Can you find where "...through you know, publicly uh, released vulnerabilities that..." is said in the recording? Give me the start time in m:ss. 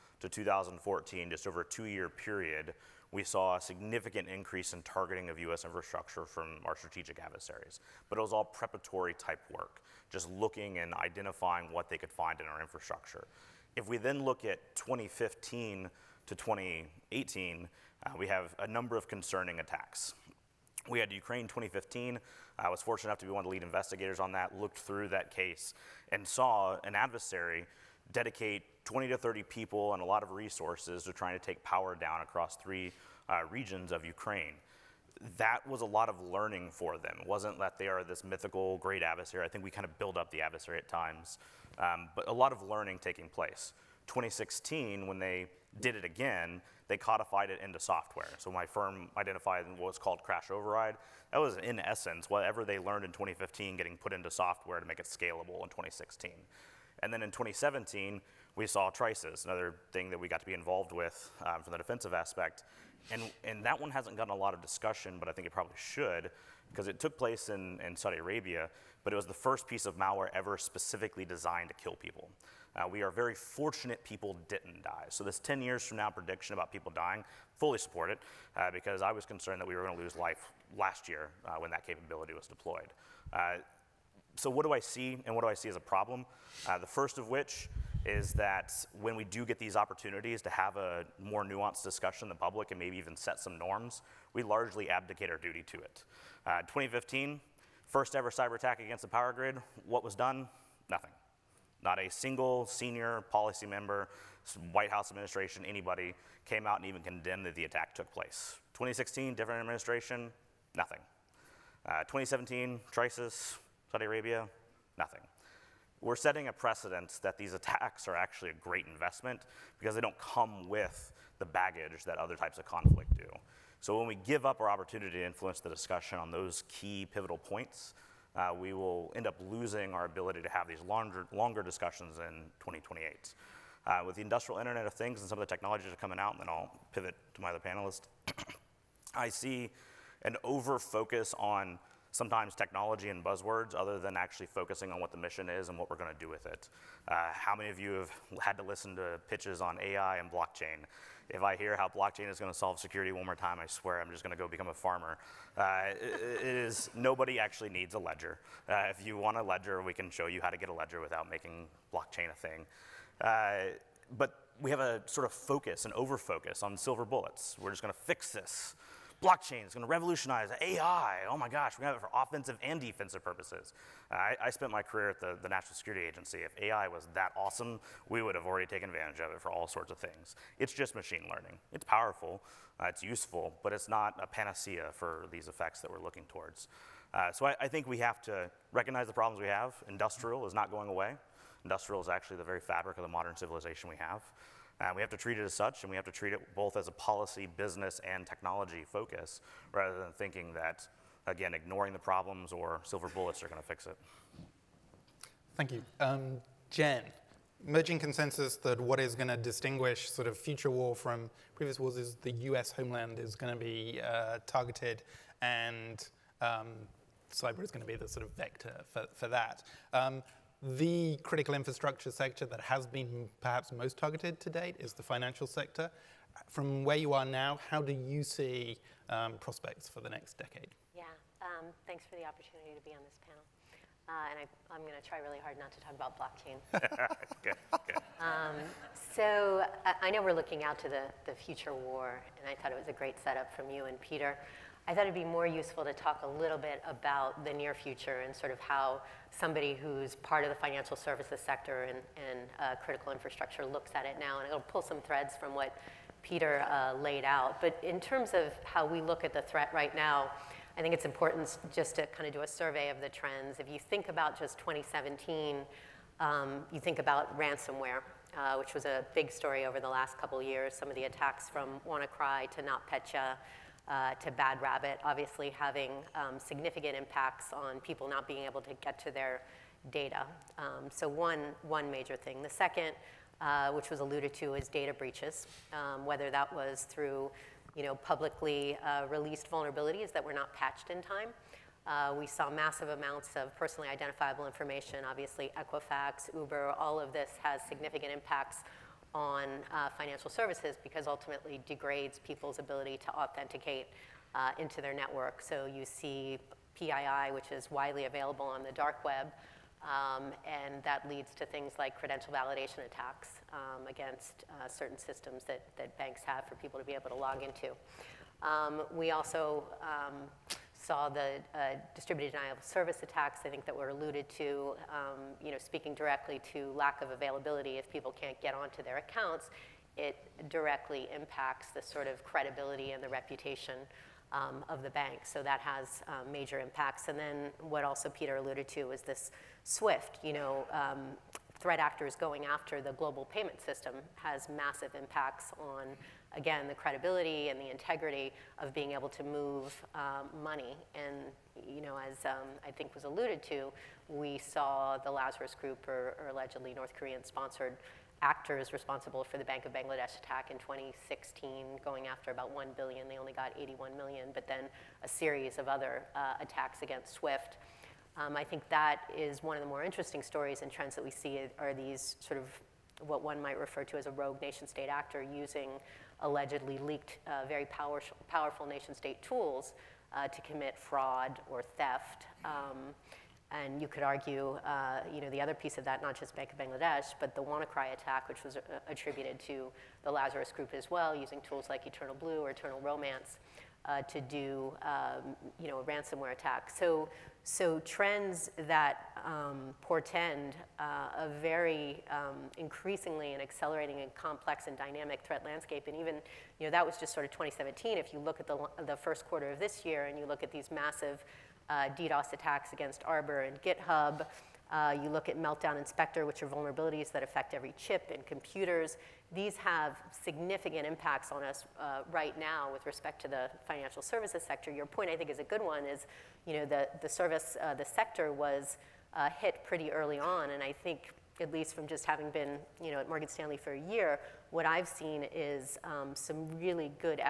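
4:46.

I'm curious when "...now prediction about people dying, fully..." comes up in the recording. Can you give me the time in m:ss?
1:15.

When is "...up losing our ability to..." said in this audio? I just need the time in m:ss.
2:09.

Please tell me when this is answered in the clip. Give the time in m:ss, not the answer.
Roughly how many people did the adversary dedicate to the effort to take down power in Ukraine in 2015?
0:28.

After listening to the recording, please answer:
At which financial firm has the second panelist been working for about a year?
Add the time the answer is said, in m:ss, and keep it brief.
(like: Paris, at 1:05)
Morgan Stanley, at 7:13.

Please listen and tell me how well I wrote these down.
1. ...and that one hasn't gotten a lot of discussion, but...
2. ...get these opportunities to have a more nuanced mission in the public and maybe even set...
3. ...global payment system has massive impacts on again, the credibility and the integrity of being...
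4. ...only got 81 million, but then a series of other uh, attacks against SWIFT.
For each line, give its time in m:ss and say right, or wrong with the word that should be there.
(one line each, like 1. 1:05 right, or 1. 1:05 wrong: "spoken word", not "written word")
1. 1:03 right
2. 1:29 wrong: "discussion", not "mission"
3. 5:42 right
4. 6:03 right.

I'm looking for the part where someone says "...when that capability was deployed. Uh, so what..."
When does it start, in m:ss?
1:21.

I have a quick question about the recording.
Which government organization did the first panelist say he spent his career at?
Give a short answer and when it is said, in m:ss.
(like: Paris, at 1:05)
National Security Agency, at 2:55.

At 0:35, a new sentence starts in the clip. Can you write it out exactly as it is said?
That was a lot of learning for them.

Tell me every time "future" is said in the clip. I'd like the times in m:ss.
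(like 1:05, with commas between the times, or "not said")
3:30, 4:01, 4:07.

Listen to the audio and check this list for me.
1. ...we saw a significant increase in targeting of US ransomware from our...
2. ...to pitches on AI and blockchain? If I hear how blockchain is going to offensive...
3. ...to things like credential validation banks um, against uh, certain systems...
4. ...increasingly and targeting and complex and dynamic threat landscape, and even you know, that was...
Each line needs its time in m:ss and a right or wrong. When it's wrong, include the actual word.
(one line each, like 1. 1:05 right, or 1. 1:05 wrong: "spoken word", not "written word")
1. 0:03 wrong: "infrastructure", not "ransomware"
2. 2:28 wrong: "solve", not "offensive"
3. 5:11 wrong: "attacks", not "banks"
4. 6:42 wrong: "accelerating", not "targeting".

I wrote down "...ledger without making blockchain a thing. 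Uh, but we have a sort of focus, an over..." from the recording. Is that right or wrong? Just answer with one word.
right.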